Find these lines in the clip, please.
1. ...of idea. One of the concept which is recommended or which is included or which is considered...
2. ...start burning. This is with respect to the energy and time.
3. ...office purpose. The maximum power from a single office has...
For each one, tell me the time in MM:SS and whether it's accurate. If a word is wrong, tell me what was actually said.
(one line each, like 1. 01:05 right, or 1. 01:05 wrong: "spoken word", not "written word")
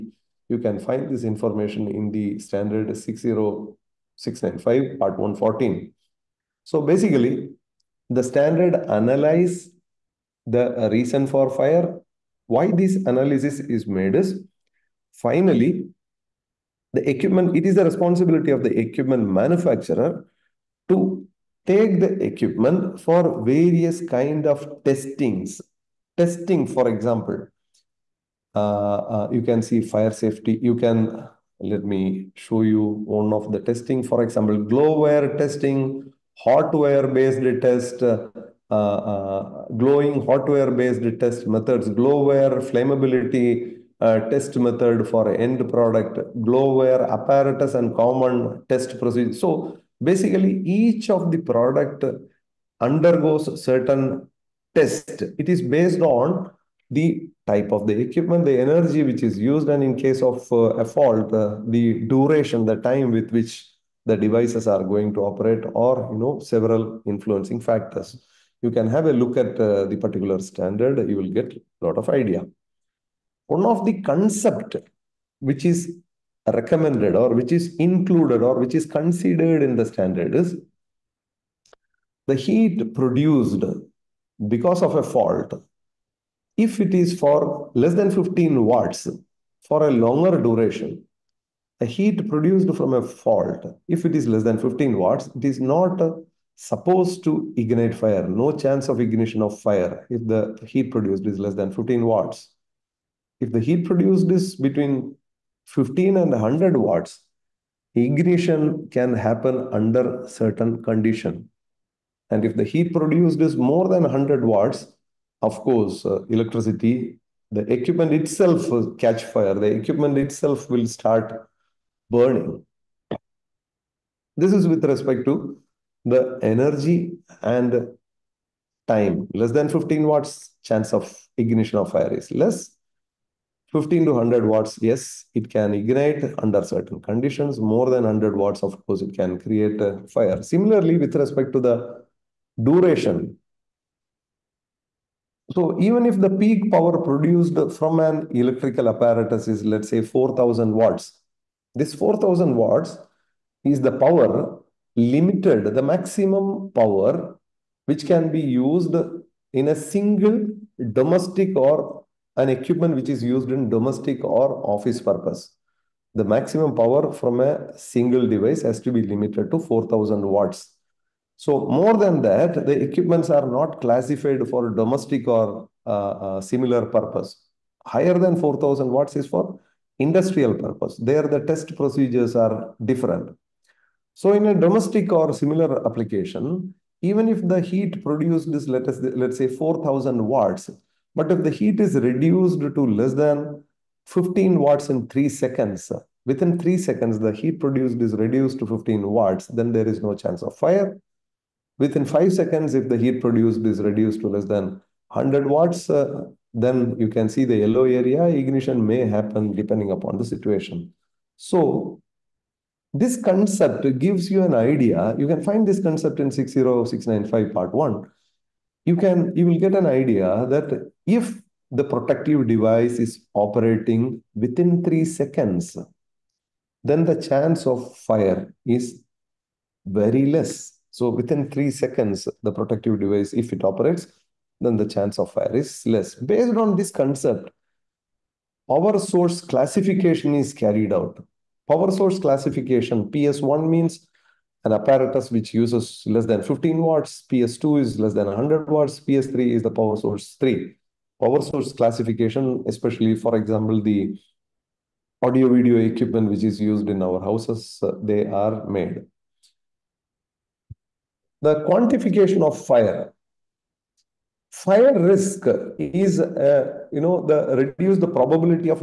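1. 01:11 right
2. 02:00 right
3. 02:44 wrong: "device", not "office".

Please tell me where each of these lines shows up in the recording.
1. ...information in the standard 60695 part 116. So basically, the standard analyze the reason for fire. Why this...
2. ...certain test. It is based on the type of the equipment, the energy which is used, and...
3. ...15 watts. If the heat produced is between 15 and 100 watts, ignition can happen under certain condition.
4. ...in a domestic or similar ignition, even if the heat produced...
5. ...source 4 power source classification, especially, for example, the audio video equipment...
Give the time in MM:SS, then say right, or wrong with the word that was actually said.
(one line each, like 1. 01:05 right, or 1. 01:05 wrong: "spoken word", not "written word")
1. 00:01 wrong: "114", not "116"
2. 00:53 right
3. 01:41 right
4. 03:04 wrong: "application", not "ignition"
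5. 04:09 wrong: "3", not "4".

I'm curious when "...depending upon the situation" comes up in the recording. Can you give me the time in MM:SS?
03:29.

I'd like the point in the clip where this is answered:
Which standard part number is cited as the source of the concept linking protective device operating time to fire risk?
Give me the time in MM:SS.
03:36.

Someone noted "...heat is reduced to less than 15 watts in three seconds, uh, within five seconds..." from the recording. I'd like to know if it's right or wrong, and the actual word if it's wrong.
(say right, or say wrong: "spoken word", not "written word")
wrong: "three", not "five".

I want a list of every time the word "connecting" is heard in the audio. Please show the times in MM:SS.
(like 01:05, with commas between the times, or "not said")
not said.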